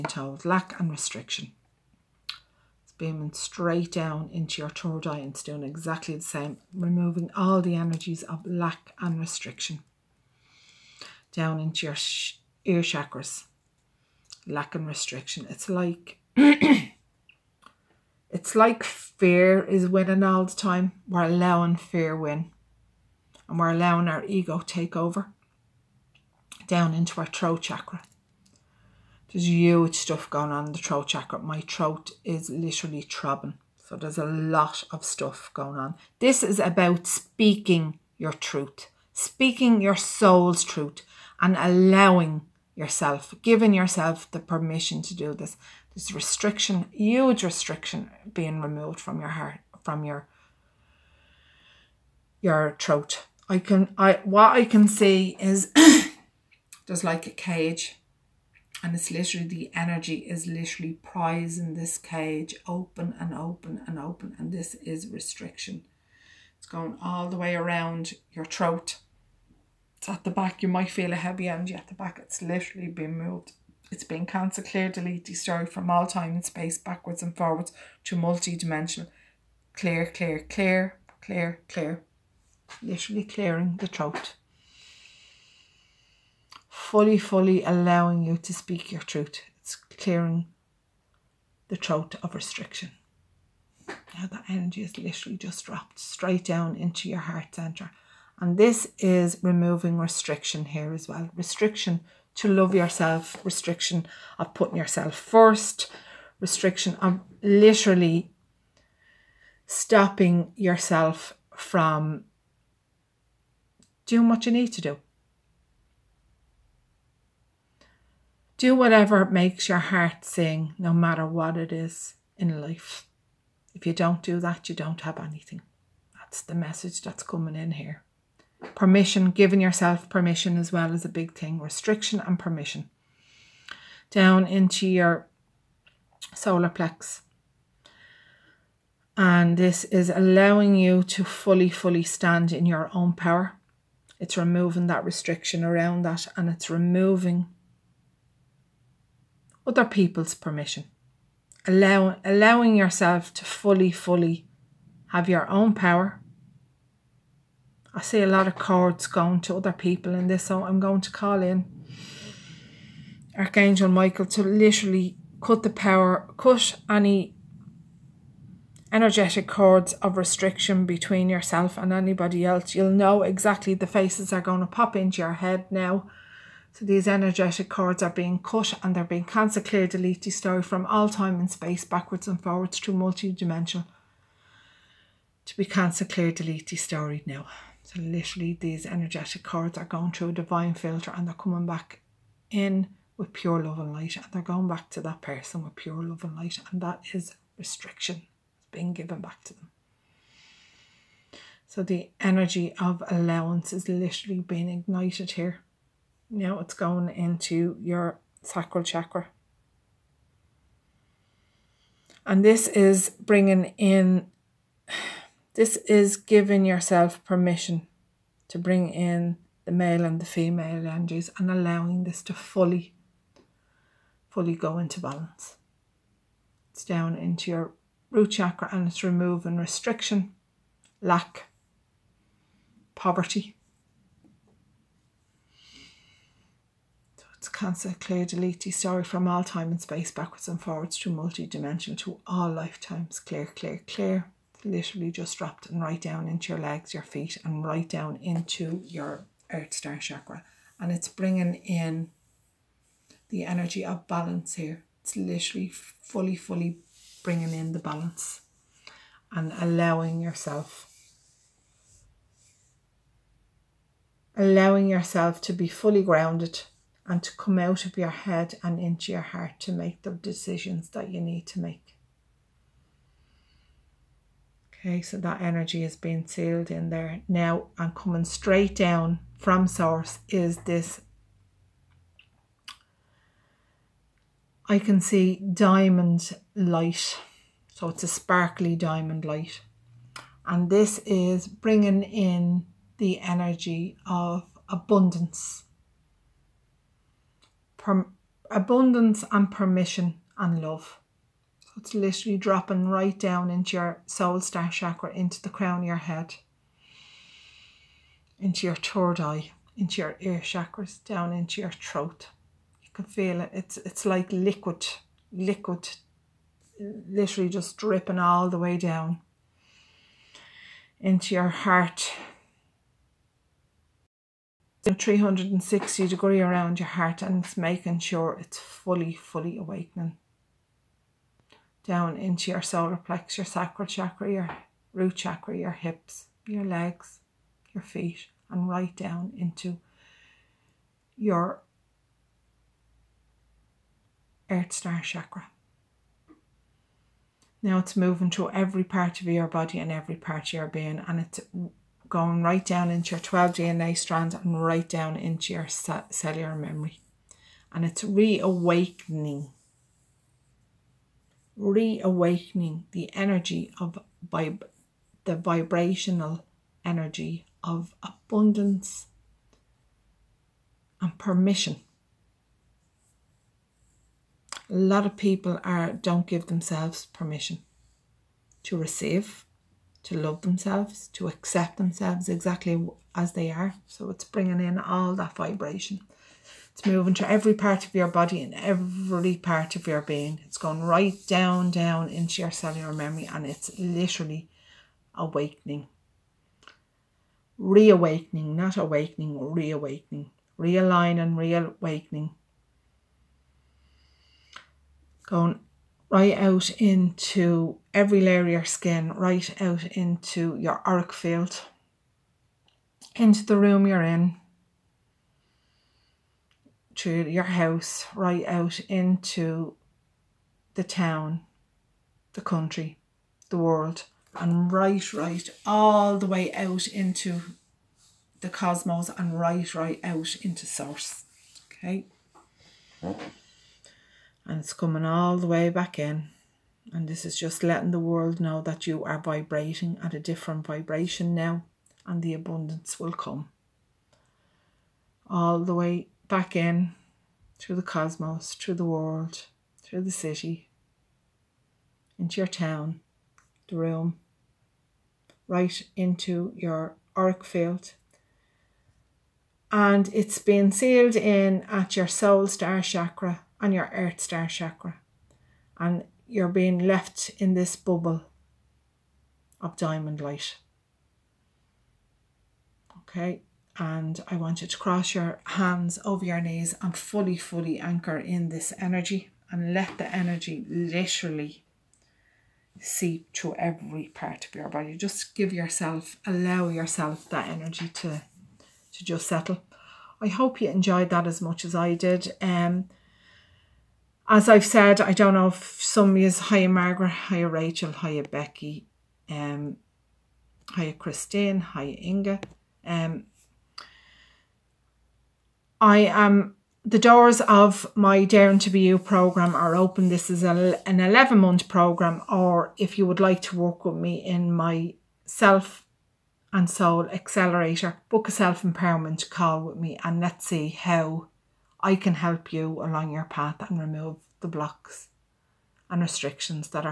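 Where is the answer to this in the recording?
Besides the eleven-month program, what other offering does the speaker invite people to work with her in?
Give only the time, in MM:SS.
08:35.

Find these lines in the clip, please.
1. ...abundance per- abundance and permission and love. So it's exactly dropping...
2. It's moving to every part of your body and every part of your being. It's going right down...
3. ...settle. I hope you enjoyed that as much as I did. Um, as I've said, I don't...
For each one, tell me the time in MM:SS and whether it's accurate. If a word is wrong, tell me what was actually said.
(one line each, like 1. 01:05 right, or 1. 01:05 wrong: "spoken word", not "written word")
1. 04:54 wrong: "literally", not "exactly"
2. 06:26 right
3. 08:09 right.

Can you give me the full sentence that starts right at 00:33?
So there's a lot of stuff going on.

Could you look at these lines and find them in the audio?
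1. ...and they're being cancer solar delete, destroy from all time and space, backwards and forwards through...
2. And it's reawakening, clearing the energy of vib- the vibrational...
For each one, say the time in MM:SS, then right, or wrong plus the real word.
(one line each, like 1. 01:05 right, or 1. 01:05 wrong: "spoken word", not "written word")
1. 02:58 wrong: "clear", not "solar"
2. 05:57 wrong: "reawakening", not "clearing".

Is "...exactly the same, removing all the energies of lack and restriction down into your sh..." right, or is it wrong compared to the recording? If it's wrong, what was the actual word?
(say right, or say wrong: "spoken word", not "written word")
right.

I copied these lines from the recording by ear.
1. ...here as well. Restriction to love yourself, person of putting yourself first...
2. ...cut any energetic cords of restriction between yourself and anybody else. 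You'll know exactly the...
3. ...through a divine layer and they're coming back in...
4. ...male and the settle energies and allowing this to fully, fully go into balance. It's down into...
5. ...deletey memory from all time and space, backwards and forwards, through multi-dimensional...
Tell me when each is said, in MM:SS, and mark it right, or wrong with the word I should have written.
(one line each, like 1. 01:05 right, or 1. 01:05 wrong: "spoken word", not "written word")
1. 01:40 wrong: "restriction", not "person"
2. 02:46 right
3. 03:10 wrong: "filter", not "layer"
4. 03:39 wrong: "female", not "settle"
5. 03:58 wrong: "story", not "memory".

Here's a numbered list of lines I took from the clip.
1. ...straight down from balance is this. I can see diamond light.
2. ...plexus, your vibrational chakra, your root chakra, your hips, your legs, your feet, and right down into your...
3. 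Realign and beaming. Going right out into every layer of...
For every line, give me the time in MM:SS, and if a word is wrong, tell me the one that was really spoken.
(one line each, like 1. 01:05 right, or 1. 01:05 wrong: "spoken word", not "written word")
1. 04:38 wrong: "source", not "balance"
2. 05:32 wrong: "sacral", not "vibrational"
3. 06:40 wrong: "reawakening", not "beaming".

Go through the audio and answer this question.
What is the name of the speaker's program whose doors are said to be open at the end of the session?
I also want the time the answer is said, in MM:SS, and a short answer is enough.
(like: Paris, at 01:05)
Daring to Be You, at 08:28.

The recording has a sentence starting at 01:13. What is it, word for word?
It's been cancer, clear, delete, destroy from all time and space, backwards and forwards to multi-dimensional.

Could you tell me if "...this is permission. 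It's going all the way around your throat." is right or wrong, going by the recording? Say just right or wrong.
wrong.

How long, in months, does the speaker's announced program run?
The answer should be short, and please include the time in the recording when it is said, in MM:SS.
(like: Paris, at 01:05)
11, at 08:30.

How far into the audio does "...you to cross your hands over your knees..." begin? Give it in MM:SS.
07:54.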